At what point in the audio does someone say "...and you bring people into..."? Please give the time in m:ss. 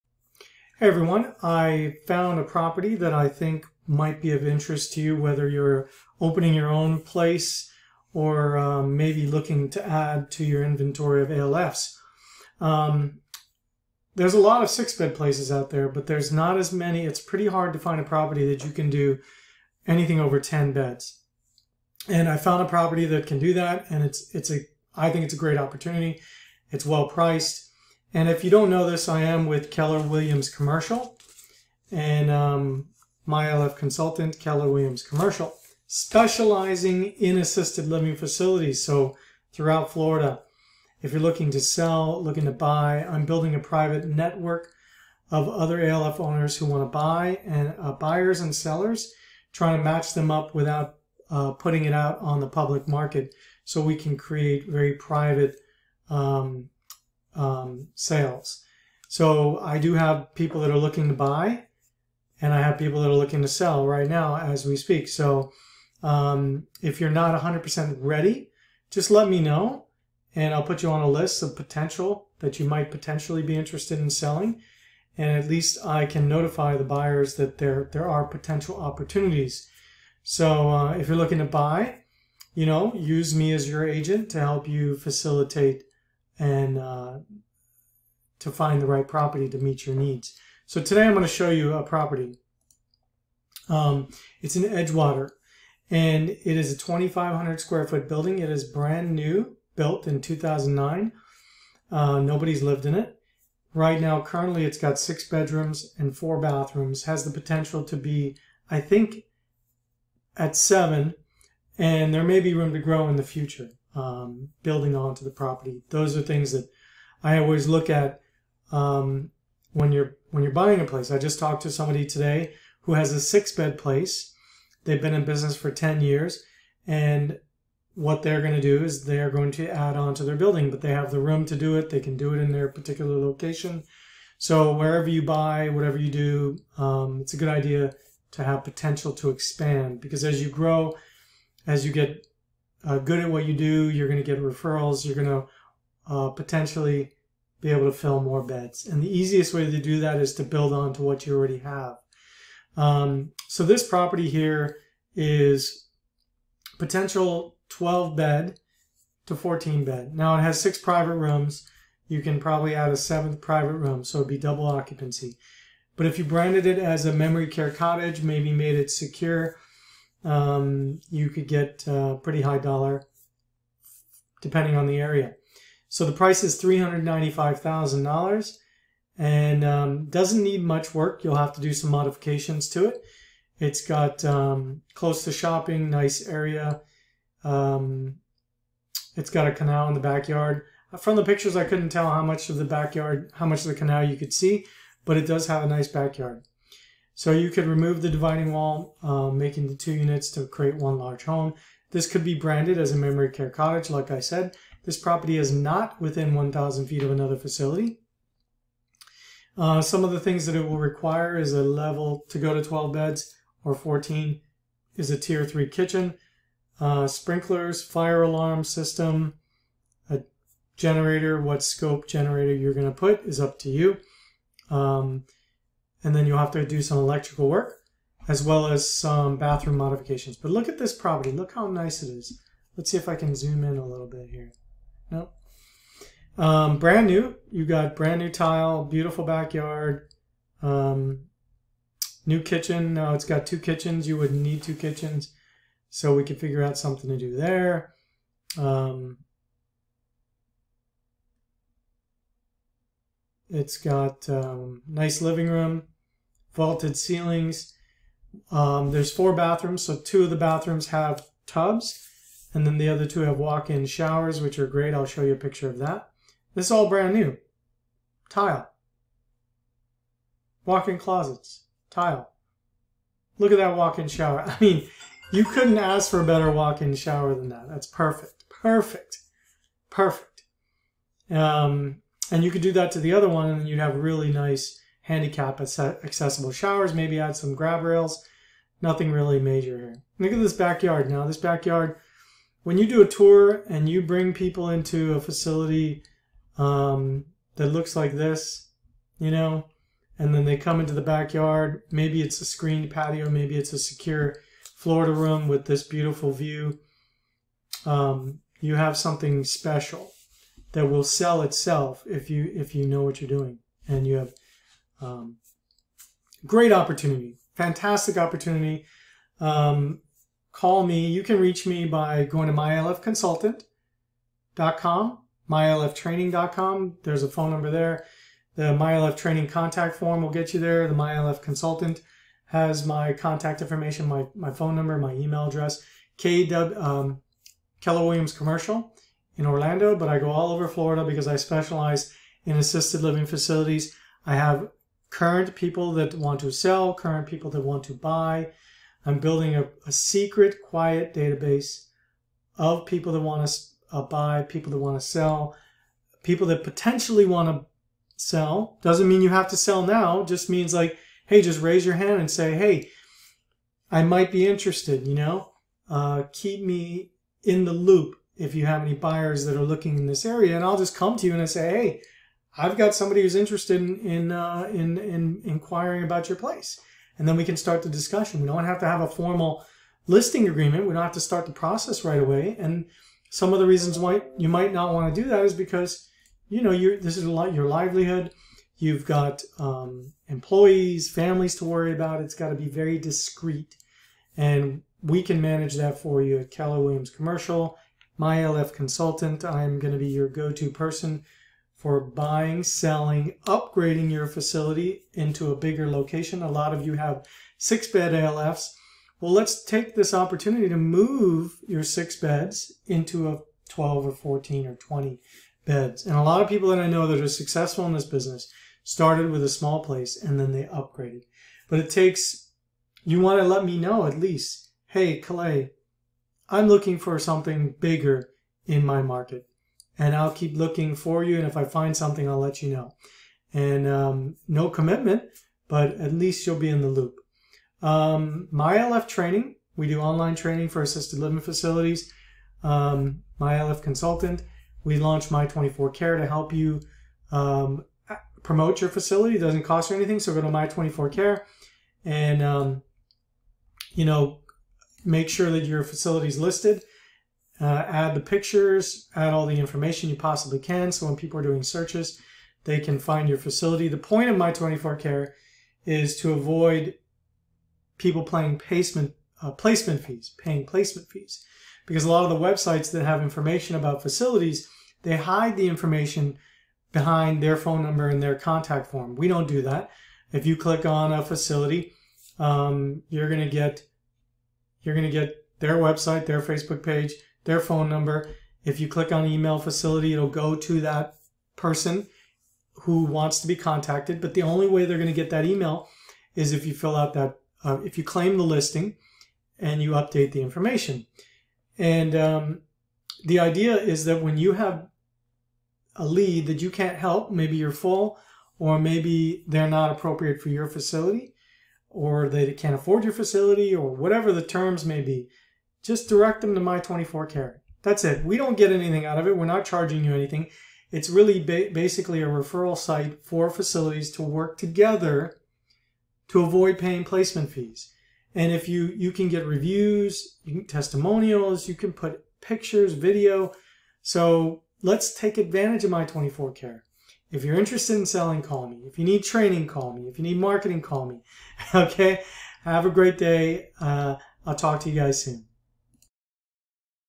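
4:53.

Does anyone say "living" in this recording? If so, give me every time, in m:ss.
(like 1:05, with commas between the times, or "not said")
0:37, 4:15, 5:43, 7:21.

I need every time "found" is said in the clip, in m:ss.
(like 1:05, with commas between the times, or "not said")
0:02, 0:22.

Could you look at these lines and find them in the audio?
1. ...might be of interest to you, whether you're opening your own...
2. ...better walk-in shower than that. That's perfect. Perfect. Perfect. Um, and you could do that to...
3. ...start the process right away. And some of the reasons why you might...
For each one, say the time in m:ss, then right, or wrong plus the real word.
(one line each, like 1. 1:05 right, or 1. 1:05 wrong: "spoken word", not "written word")
1. 0:03 right
2. 4:36 right
3. 6:21 right.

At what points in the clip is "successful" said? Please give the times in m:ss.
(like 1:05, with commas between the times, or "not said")
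6:57.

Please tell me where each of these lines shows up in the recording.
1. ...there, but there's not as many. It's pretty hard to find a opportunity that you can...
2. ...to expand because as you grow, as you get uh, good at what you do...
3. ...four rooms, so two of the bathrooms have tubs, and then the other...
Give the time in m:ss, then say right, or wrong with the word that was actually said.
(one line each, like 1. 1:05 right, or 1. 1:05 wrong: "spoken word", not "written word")
1. 0:15 wrong: "property", not "opportunity"
2. 2:19 right
3. 4:19 wrong: "bathrooms", not "rooms".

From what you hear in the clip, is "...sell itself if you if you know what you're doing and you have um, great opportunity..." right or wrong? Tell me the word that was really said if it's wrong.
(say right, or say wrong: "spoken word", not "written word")
right.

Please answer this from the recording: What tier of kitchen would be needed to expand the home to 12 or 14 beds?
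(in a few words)
Tier 3.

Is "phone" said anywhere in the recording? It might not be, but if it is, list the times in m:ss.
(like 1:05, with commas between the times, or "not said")
5:27, 5:34, 7:57, 8:07.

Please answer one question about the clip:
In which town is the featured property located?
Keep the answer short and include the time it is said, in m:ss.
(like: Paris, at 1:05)
Edgewater, at 1:34.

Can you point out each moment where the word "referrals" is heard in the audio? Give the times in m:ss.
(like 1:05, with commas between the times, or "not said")
2:24, 8:42.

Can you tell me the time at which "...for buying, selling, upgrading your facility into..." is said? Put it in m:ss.
6:41.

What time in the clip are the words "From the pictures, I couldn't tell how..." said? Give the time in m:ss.
3:10.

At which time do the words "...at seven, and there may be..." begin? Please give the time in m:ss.
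1:50.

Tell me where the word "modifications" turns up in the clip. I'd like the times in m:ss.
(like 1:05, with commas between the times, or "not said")
3:01, 3:49.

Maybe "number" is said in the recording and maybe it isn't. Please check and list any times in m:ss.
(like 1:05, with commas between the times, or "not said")
5:27, 5:34, 7:57, 8:07.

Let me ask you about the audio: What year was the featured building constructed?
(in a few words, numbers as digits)
2009.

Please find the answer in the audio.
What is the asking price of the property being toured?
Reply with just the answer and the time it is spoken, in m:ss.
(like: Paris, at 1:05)
$395,000, at 2:56.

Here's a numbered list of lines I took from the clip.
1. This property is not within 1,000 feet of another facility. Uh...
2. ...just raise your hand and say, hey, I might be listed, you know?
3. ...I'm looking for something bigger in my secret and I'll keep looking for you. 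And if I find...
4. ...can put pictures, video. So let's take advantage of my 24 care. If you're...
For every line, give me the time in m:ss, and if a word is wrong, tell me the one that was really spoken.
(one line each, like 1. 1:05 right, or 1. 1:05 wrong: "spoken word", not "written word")
1. 3:24 right
2. 6:01 wrong: "interested", not "listed"
3. 7:06 wrong: "market", not "secret"
4. 8:51 right.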